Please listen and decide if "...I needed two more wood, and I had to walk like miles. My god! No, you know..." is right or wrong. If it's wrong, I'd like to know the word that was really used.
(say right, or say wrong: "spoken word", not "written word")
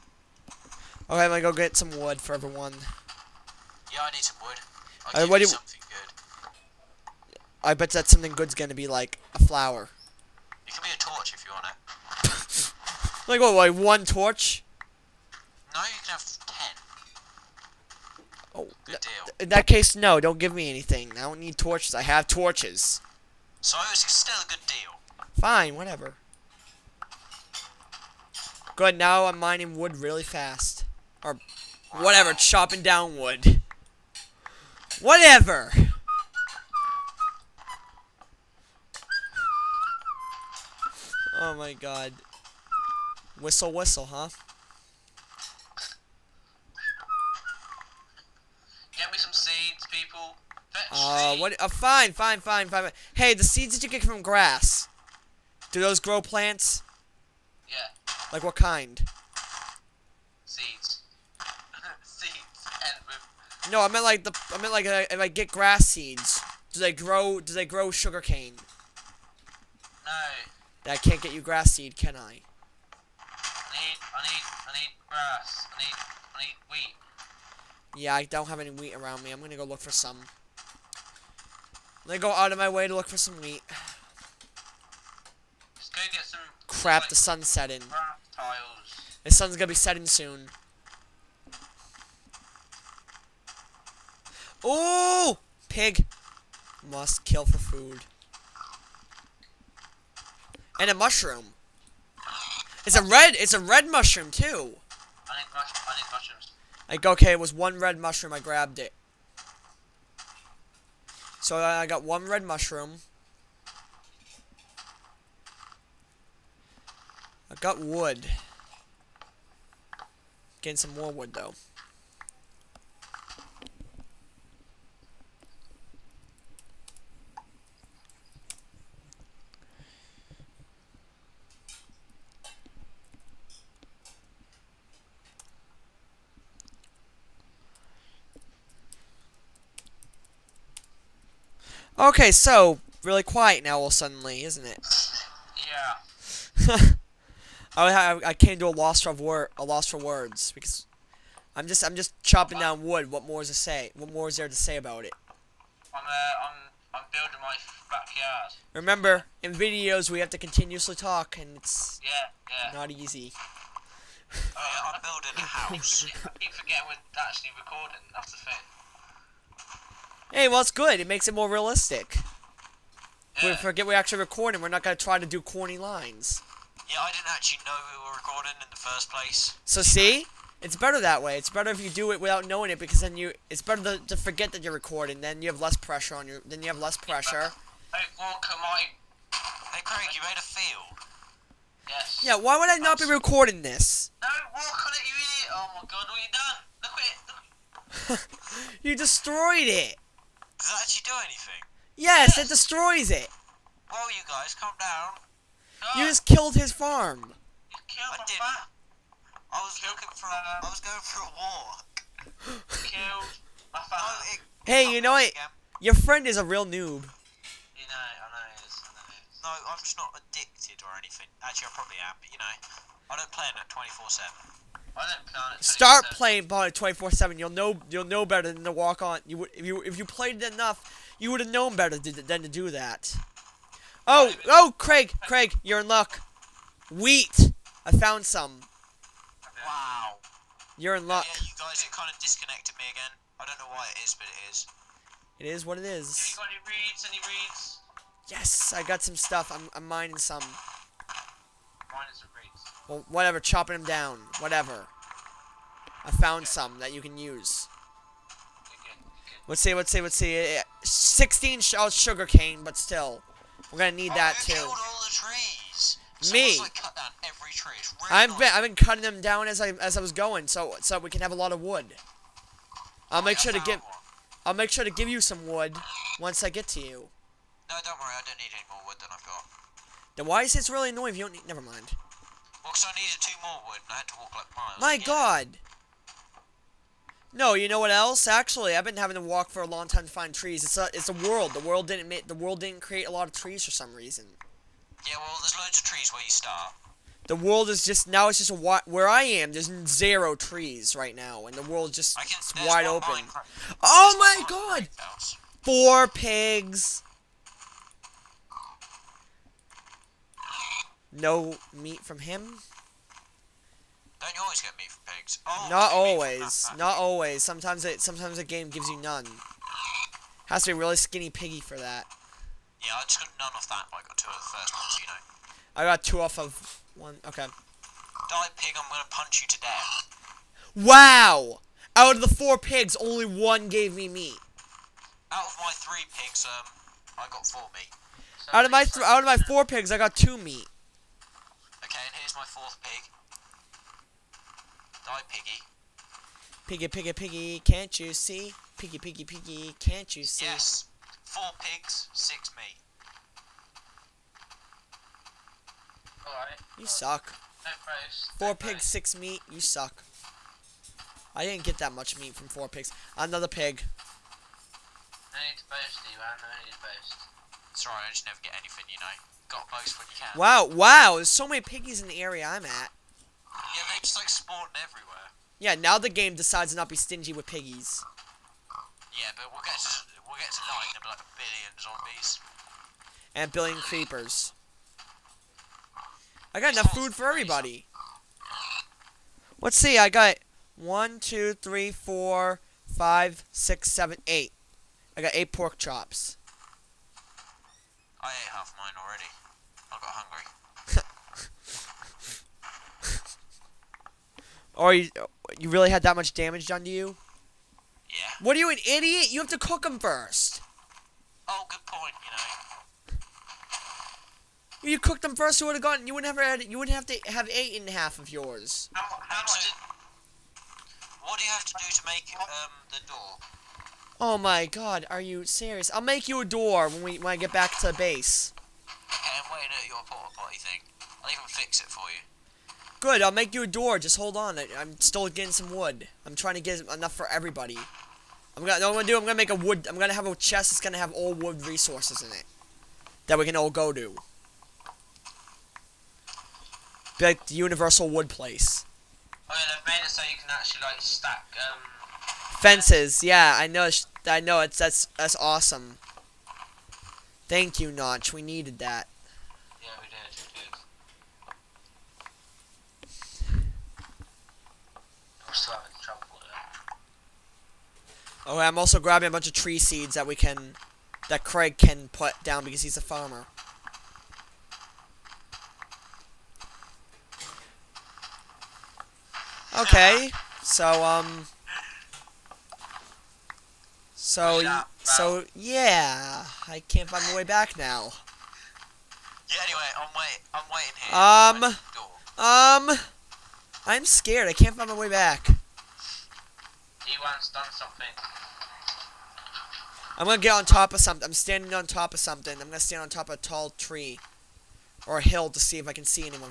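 right.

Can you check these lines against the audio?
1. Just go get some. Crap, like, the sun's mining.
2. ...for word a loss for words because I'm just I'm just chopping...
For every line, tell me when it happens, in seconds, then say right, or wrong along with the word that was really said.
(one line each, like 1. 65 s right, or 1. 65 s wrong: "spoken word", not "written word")
1. 85 s wrong: "setting", not "mining"
2. 149 s right.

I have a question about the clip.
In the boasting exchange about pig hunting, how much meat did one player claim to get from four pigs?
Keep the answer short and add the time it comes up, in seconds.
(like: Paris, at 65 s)
6, at 352 s.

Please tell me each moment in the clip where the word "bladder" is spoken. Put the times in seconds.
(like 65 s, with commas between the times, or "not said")
not said.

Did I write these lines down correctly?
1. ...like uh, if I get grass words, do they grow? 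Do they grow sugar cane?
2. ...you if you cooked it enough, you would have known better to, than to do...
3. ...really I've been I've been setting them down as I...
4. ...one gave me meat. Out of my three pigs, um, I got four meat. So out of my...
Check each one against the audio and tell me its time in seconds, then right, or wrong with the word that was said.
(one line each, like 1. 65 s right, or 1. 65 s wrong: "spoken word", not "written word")
1. 64 s wrong: "seeds", not "words"
2. 229 s wrong: "played", not "cooked"
3. 266 s wrong: "cutting", not "setting"
4. 333 s right.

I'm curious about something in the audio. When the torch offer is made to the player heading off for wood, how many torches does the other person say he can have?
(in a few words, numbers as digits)
10.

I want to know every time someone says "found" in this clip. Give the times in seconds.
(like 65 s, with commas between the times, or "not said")
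237 s, 256 s.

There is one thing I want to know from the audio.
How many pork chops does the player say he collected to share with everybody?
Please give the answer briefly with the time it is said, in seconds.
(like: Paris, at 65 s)
8, at 395 s.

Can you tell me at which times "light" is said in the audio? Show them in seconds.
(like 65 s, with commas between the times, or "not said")
not said.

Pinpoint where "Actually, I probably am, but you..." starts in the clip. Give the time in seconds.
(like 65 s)
221 s.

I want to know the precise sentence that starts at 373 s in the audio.
Yeah, they just like spawn everywhere.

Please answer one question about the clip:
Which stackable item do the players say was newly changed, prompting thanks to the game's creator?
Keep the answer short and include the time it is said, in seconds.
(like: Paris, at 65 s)
Fences, at 452 s.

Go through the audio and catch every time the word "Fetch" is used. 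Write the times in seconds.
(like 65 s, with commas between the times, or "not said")
50 s.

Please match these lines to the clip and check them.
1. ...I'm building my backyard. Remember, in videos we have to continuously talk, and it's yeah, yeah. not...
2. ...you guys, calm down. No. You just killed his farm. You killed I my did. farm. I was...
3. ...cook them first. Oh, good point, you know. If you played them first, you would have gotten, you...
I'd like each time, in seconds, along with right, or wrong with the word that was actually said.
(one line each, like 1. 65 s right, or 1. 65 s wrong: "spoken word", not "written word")
1. 156 s right
2. 204 s right
3. 409 s wrong: "cooked", not "played".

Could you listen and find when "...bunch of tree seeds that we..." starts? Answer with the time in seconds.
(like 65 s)
469 s.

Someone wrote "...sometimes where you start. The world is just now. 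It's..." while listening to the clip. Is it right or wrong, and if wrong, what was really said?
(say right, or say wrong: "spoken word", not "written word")
wrong: "trees", not "sometimes".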